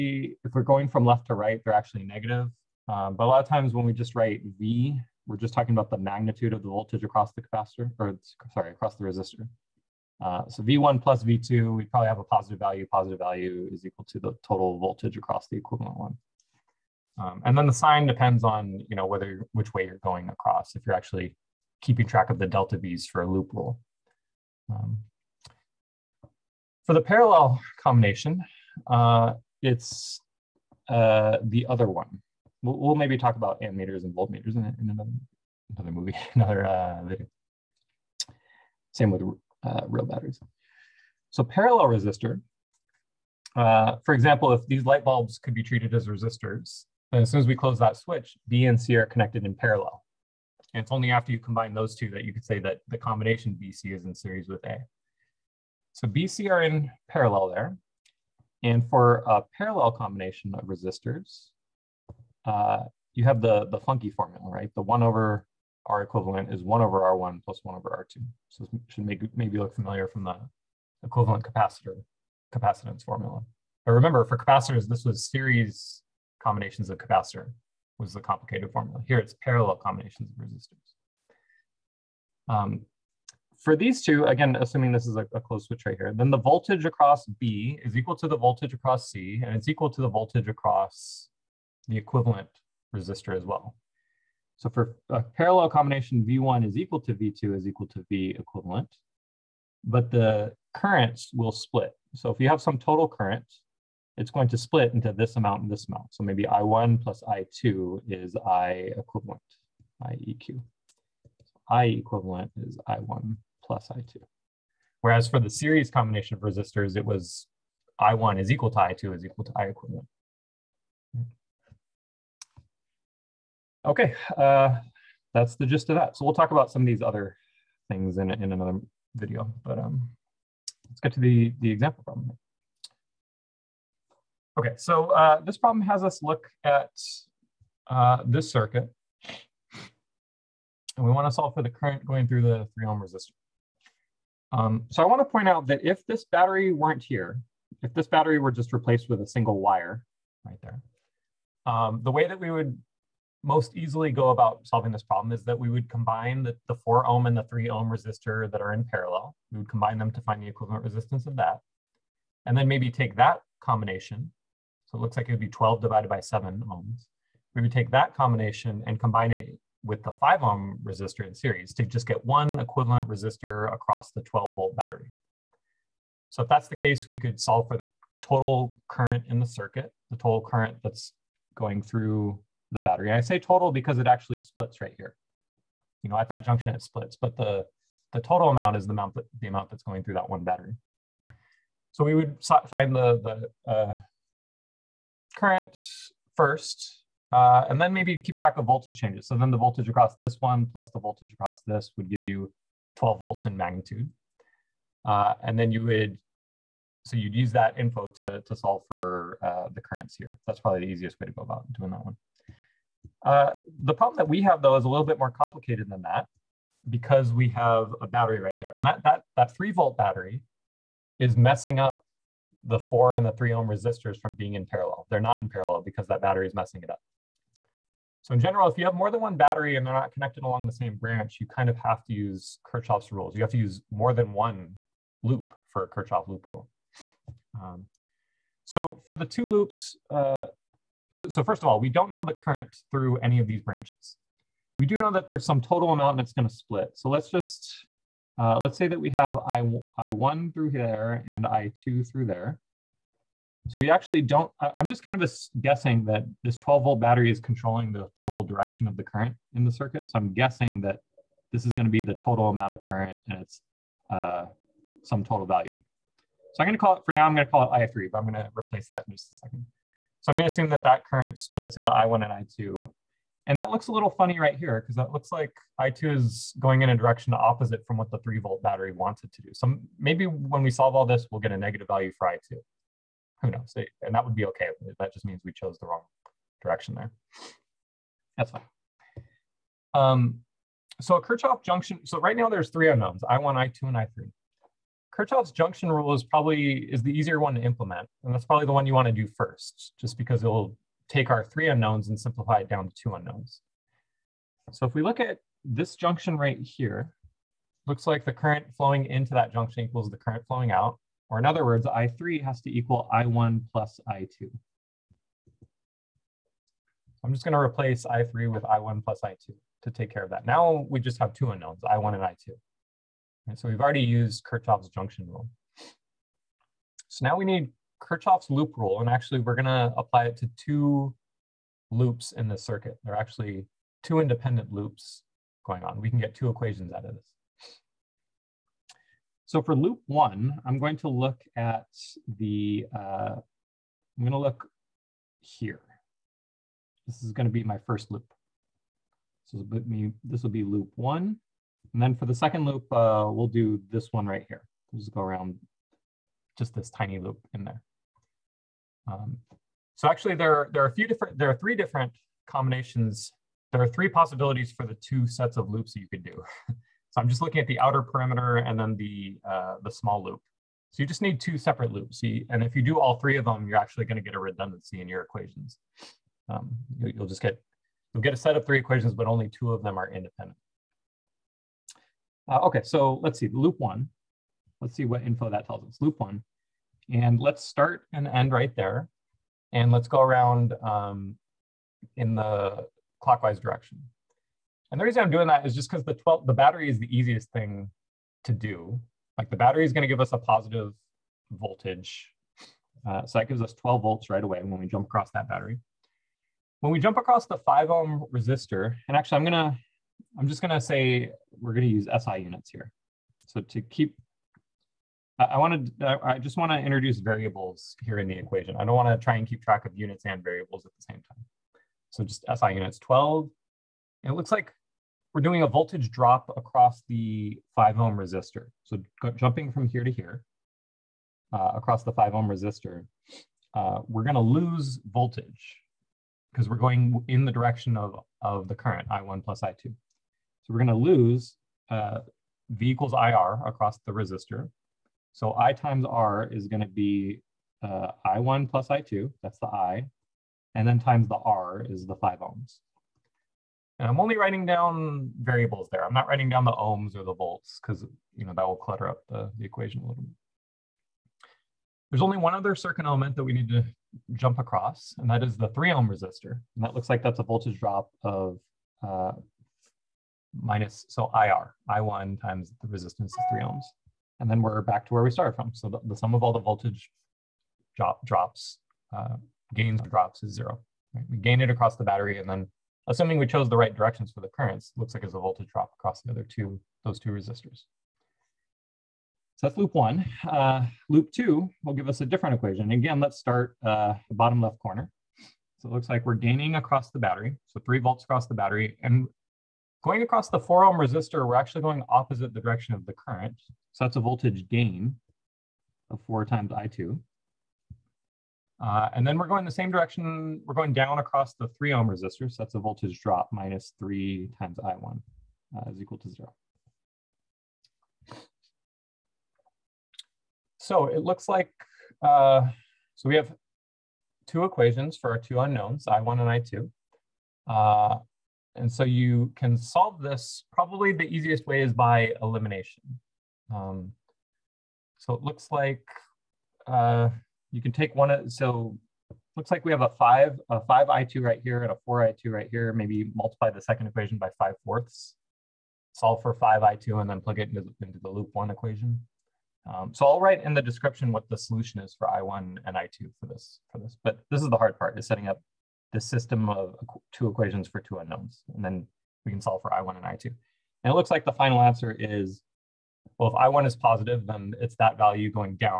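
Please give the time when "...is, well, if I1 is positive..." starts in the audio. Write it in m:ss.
9:22.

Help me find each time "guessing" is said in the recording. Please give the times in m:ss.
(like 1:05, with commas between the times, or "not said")
4:15, 4:20.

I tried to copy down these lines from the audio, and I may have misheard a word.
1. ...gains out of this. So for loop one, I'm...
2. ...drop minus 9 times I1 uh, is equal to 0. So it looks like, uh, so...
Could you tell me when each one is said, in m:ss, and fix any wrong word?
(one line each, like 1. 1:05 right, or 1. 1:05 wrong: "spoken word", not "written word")
1. 5:36 wrong: "equations", not "gains"
2. 8:33 wrong: "3", not "9".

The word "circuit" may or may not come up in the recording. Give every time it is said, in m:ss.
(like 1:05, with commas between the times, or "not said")
2:18, 2:59, 4:19, 5:32, 7:42.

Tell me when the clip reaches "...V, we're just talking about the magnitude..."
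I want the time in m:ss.
0:04.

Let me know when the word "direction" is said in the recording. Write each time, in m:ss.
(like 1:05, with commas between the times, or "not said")
4:18, 4:36, 4:46, 6:33, 7:17, 8:03, 8:22, 8:29.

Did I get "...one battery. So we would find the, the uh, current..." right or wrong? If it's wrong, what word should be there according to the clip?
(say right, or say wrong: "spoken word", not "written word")
right.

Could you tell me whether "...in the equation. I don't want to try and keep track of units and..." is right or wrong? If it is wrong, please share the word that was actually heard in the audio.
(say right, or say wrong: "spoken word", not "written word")
right.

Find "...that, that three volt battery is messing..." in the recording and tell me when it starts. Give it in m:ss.
3:39.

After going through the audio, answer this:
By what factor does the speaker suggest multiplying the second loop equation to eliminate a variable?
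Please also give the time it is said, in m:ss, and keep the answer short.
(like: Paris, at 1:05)
5/4, at 9:04.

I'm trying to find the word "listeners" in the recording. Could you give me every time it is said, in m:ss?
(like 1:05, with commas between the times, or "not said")
not said.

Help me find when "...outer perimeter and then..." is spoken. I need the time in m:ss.
6:07.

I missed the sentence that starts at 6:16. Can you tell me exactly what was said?
Um, you'll just get, you'll get a set of three equations, but only two of them are independent.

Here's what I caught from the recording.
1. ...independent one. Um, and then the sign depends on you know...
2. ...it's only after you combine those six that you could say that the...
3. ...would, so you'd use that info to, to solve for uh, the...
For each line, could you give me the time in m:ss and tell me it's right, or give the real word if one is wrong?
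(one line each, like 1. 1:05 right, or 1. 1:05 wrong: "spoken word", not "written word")
1. 0:15 wrong: "equivalent", not "independent"
2. 0:50 wrong: "two", not "six"
3. 3:25 right.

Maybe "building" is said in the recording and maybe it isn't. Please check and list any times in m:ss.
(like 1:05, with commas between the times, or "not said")
not said.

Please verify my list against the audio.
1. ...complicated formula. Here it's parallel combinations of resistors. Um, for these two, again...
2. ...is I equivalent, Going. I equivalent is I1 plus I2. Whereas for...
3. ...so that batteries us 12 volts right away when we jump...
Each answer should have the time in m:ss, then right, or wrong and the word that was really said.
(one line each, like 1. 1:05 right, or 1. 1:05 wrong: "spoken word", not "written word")
1. 1:18 right
2. 1:48 wrong: "IEQ", not "Going"
3. 6:43 wrong: "gives", not "batteries".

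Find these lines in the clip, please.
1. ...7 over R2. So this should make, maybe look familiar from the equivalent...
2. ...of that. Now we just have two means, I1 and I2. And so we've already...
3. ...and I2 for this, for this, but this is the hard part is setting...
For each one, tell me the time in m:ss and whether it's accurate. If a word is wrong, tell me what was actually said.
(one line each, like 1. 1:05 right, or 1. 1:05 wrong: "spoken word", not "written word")
1. 1:07 wrong: "1", not "7"
2. 5:20 wrong: "unknowns", not "means"
3. 9:12 right.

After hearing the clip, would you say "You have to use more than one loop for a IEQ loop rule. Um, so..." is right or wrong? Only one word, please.
wrong.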